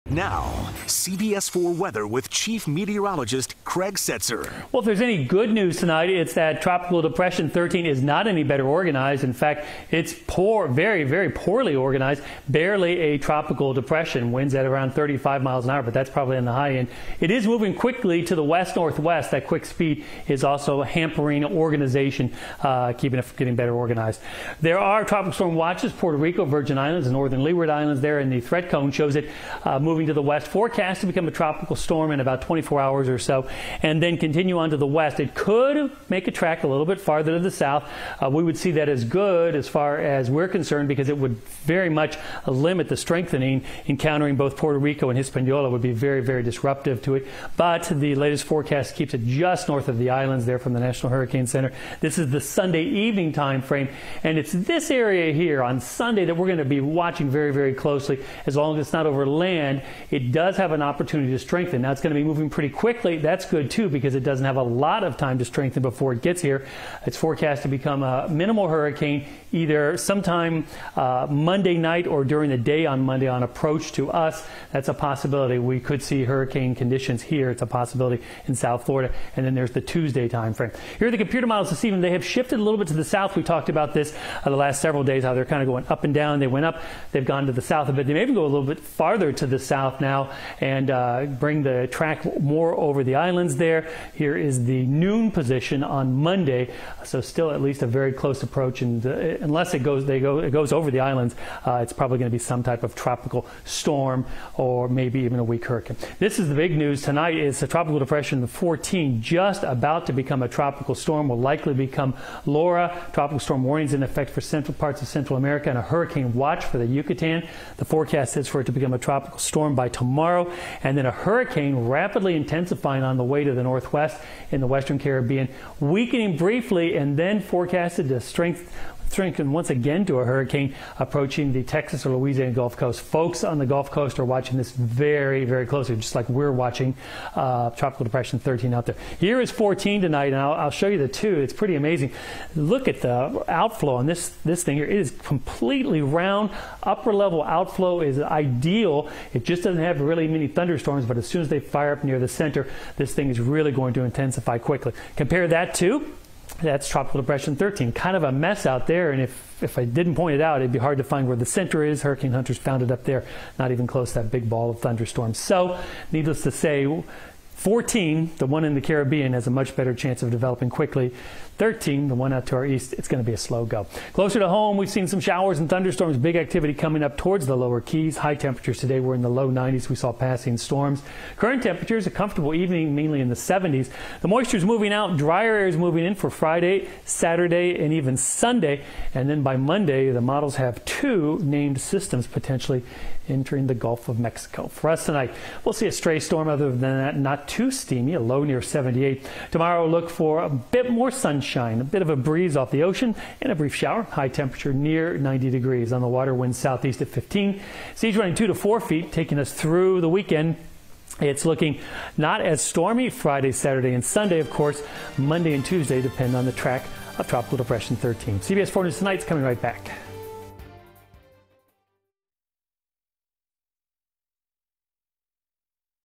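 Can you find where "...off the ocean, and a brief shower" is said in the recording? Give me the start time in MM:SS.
03:22.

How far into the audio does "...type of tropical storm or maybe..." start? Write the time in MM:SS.
01:42.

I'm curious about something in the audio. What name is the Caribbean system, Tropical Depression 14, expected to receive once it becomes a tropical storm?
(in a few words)
Laura.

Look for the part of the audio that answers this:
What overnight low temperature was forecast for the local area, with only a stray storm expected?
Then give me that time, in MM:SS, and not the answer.
03:18.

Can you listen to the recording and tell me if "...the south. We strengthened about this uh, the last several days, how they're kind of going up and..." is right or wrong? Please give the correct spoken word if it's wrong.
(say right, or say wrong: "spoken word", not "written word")
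wrong: "talked", not "strengthened".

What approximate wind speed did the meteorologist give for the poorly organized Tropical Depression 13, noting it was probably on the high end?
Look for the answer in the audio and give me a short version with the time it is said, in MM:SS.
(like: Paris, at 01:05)
35 miles an hour, at 00:14.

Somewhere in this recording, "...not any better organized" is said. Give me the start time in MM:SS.
00:08.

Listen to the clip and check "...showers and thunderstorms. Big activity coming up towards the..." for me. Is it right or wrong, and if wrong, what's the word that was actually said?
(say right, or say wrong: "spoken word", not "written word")
right.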